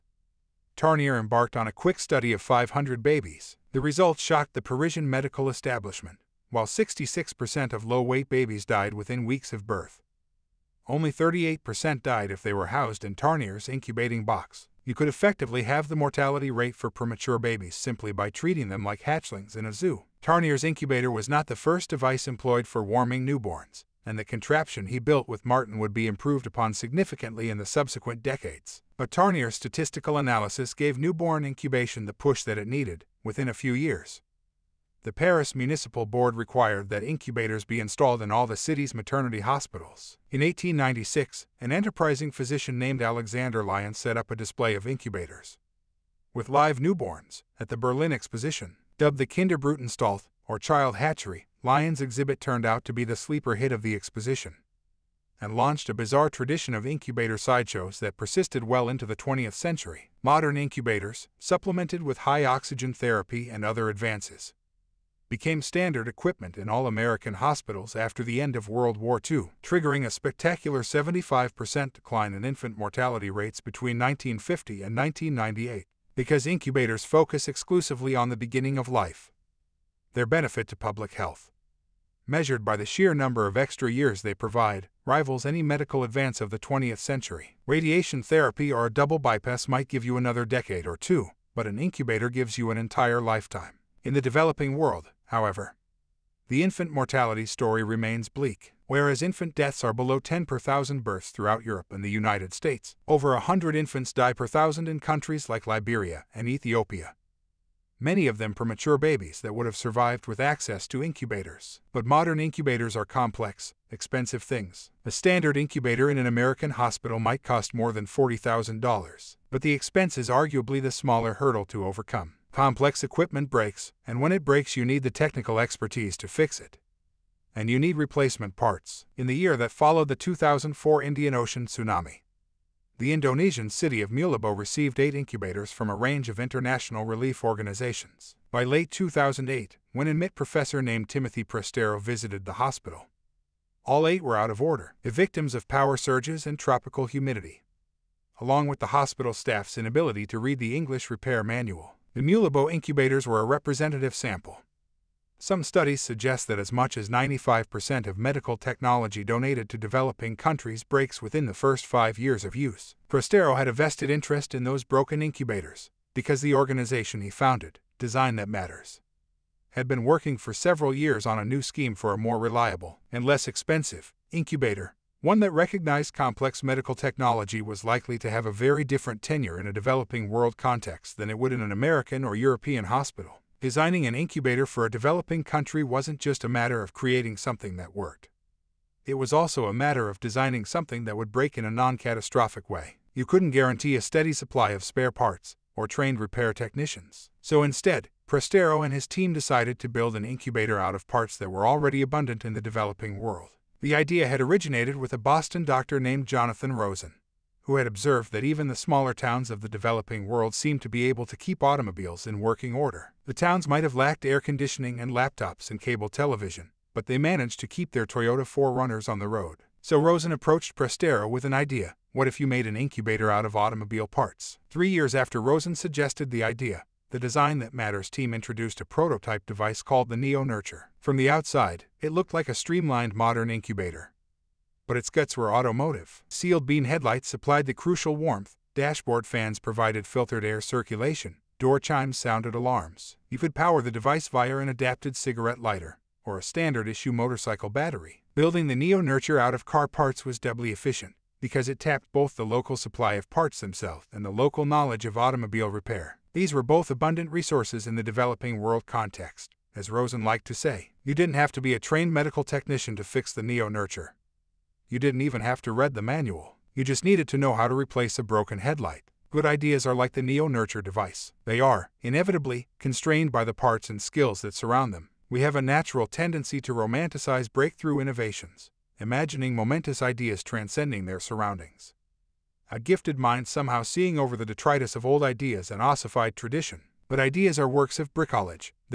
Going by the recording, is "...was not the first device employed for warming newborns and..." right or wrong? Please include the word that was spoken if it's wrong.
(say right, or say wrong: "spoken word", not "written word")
right.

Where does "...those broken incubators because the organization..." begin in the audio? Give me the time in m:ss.
2:44.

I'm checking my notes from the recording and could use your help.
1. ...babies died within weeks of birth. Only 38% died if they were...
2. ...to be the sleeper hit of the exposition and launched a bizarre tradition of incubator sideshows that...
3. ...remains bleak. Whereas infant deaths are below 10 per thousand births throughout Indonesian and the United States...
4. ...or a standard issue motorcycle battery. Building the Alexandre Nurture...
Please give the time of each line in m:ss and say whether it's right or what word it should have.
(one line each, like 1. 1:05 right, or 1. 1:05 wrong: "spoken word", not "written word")
1. 0:08 right
2. 0:52 right
3. 1:37 wrong: "Europe", not "Indonesian"
4. 4:06 wrong: "Neo", not "Alexandre".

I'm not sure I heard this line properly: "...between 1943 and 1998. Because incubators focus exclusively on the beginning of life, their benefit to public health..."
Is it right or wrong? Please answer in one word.
wrong.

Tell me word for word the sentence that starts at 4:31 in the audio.
They are, inevitably, constrained by the parts and skills that surround them.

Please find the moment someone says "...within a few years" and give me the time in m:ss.
0:33.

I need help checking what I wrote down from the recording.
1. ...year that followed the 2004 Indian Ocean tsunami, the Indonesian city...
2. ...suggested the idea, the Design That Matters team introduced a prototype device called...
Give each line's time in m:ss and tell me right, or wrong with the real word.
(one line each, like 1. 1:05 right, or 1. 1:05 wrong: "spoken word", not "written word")
1. 2:09 right
2. 3:45 right.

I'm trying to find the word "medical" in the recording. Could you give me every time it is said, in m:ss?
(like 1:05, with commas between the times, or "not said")
0:05, 1:25, 2:38, 2:56, 4:22.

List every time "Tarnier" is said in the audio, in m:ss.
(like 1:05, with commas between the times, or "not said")
0:00, 0:13, 0:20, 0:29.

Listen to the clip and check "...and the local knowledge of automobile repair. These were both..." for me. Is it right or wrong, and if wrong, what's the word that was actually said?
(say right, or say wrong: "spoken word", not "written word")
right.